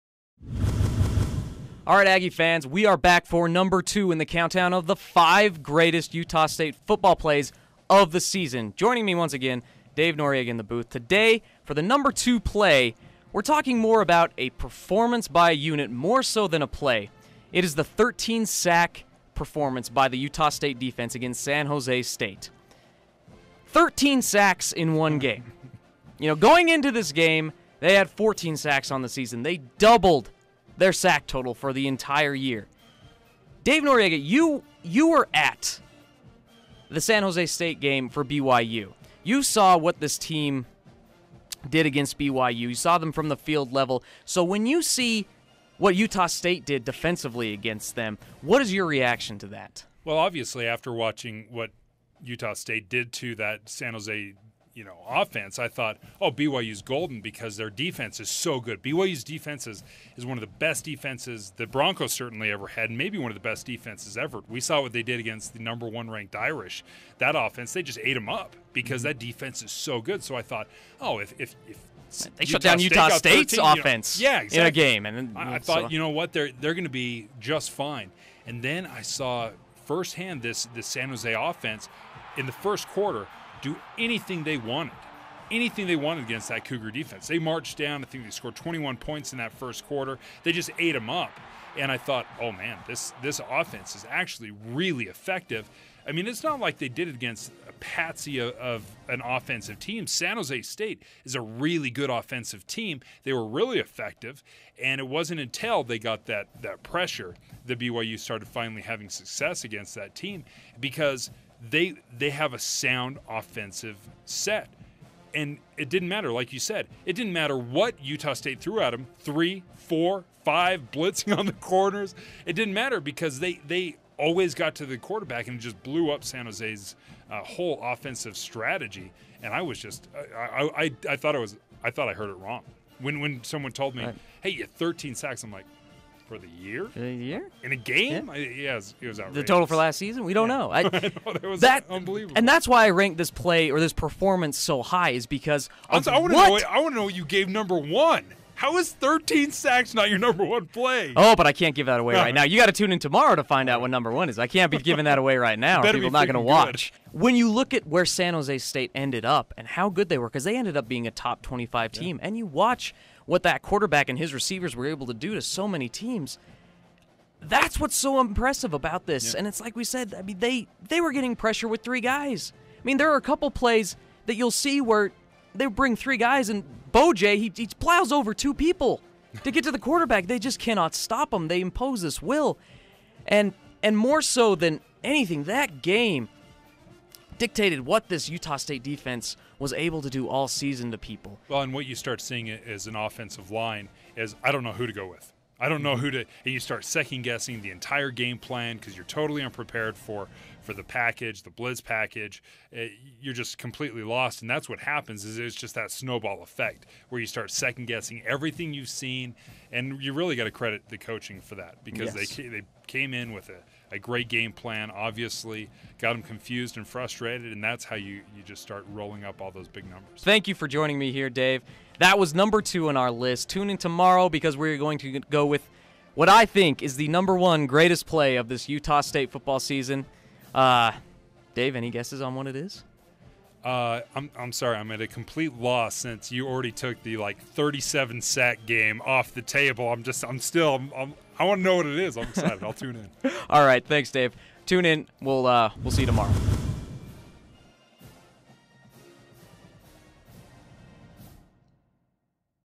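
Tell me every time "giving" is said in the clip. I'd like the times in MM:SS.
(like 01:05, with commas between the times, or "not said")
02:34.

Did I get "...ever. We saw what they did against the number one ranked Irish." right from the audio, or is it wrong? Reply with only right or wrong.
right.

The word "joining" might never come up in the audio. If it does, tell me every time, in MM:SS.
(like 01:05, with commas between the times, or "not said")
00:08, 03:40.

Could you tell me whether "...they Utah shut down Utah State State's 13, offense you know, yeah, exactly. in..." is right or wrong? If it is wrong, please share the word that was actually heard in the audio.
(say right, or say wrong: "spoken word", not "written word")
right.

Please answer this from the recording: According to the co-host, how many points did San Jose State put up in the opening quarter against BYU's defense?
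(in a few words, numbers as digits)
21.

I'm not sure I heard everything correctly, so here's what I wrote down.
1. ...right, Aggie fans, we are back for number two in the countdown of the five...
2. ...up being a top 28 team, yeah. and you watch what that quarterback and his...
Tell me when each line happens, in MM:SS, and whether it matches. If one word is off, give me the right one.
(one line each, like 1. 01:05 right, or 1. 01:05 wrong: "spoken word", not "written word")
1. 00:01 right
2. 02:40 wrong: "25", not "28".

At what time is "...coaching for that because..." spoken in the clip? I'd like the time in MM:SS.
03:30.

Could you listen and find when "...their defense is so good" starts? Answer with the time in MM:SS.
00:57.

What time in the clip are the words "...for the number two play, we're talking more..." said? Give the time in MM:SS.
00:11.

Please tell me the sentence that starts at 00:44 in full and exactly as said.
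So when you see what Utah State did defensively against them, what is your reaction to that?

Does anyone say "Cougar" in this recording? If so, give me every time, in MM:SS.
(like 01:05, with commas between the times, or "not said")
01:26.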